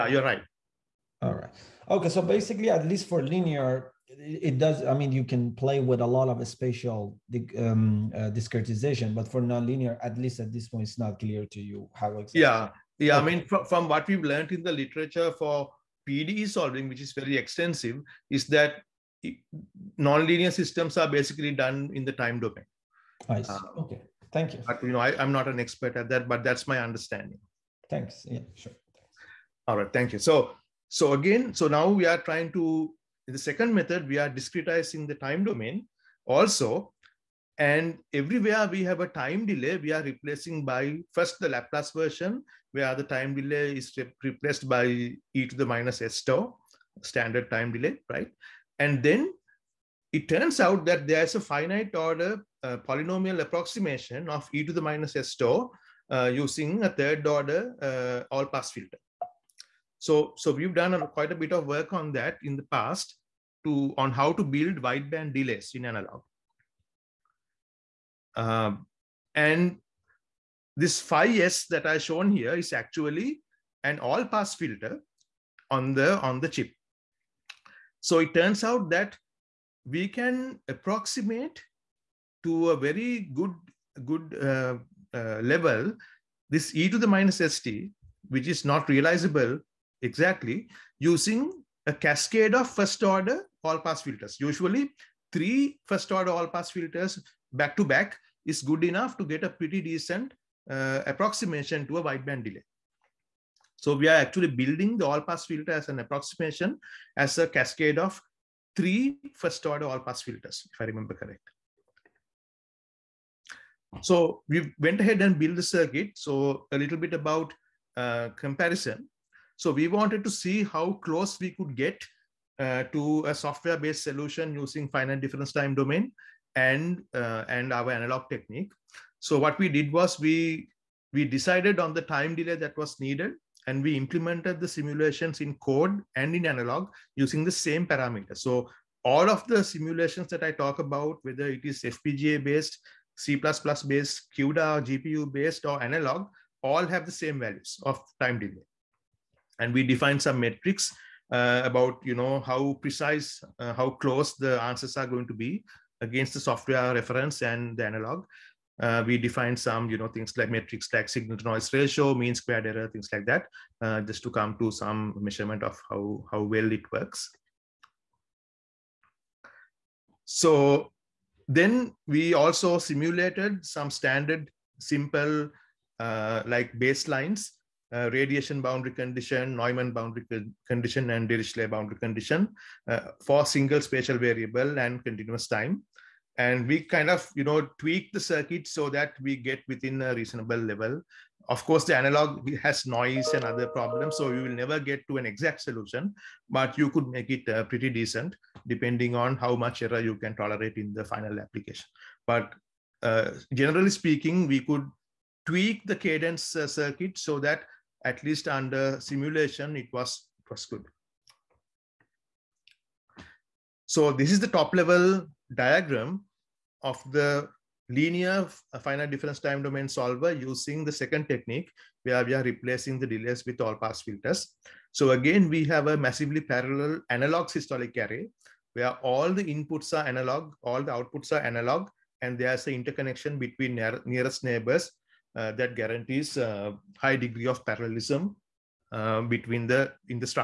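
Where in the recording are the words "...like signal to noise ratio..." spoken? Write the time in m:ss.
2:40.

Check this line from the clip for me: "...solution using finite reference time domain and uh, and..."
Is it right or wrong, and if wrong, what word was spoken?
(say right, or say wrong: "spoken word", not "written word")
wrong: "difference", not "reference".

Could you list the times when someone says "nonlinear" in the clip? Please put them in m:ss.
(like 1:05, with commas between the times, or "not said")
0:09, 0:19.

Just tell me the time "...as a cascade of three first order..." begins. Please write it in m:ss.
1:47.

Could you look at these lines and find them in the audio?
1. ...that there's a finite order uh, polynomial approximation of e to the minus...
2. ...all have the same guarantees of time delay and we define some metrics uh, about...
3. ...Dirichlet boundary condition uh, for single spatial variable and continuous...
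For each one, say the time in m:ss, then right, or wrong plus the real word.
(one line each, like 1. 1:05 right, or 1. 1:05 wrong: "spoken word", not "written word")
1. 0:50 right
2. 2:26 wrong: "values", not "guarantees"
3. 3:01 right.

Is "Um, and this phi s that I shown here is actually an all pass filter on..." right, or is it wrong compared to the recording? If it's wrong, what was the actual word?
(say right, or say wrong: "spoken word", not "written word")
right.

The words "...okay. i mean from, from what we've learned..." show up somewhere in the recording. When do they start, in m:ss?
0:13.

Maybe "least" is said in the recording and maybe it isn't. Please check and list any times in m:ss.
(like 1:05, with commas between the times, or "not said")
0:02, 0:10, 3:28.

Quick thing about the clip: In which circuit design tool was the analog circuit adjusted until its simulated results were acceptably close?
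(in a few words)
Cadence.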